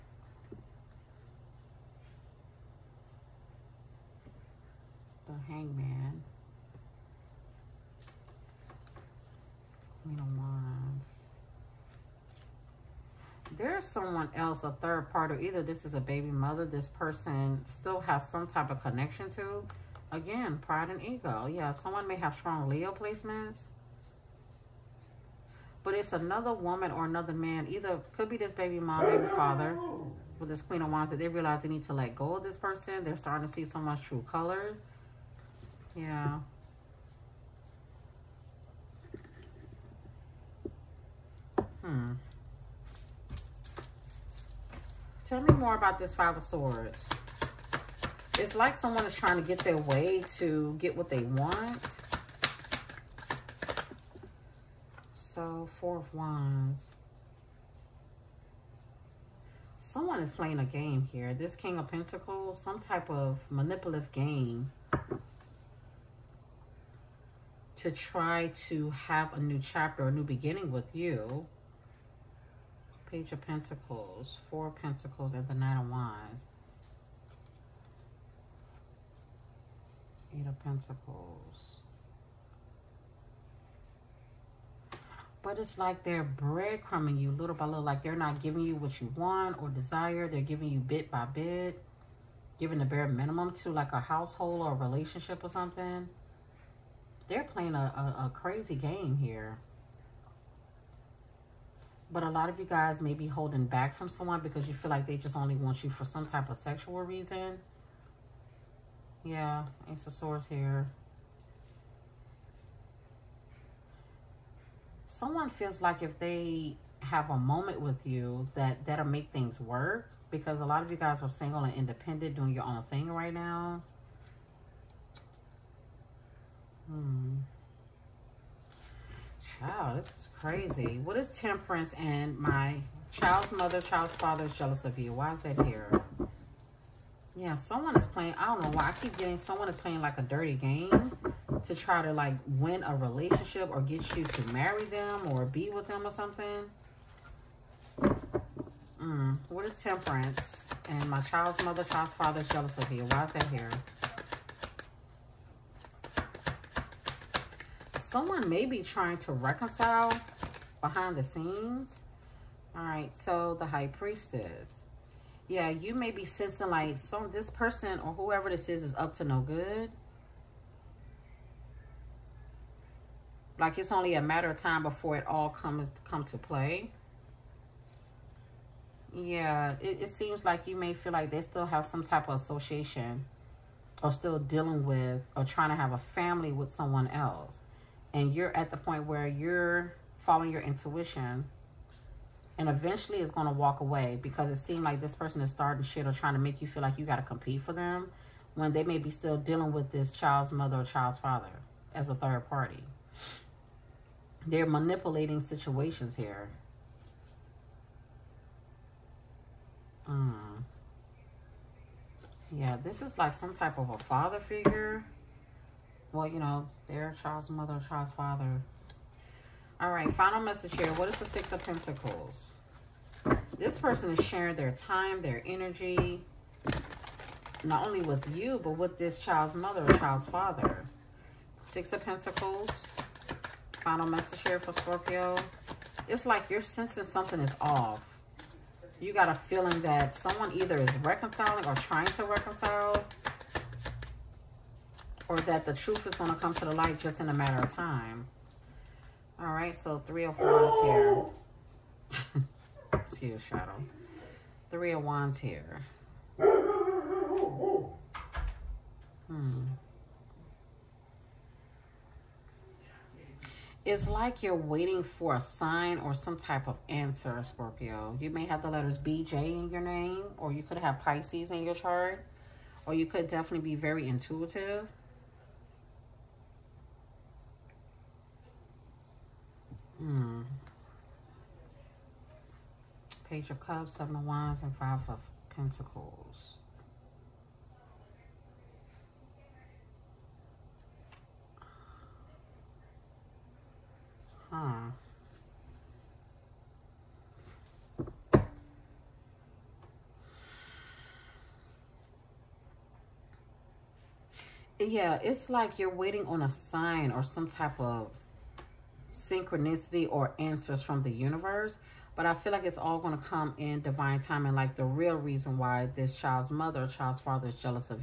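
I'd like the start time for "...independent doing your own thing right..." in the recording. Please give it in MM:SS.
02:01.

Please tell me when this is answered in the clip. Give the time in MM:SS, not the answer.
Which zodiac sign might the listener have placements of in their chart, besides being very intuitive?
04:30.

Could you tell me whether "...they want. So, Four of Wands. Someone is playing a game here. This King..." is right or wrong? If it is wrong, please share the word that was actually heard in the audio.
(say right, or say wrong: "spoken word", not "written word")
right.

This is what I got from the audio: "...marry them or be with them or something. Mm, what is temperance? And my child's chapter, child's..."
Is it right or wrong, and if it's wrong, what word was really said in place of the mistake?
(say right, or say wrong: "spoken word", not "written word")
wrong: "mother", not "chapter".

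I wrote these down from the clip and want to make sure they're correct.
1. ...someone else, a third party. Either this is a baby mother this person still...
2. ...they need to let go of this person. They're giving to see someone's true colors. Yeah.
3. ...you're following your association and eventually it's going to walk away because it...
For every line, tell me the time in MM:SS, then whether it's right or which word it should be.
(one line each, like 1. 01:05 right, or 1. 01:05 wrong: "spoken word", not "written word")
1. 00:13 right
2. 00:31 wrong: "starting", not "giving"
3. 03:09 wrong: "intuition", not "association".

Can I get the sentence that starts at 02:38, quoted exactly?
someone may be trying to reconcile behind the scenes.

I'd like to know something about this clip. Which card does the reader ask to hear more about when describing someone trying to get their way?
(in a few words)
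Five of Swords.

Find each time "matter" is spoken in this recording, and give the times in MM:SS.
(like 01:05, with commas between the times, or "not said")
02:54, 04:07.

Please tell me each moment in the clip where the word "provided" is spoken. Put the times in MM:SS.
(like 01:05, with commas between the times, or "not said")
not said.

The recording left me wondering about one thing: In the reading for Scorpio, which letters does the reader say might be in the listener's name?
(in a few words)
BJ.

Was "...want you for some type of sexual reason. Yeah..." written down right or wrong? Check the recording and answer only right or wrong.
right.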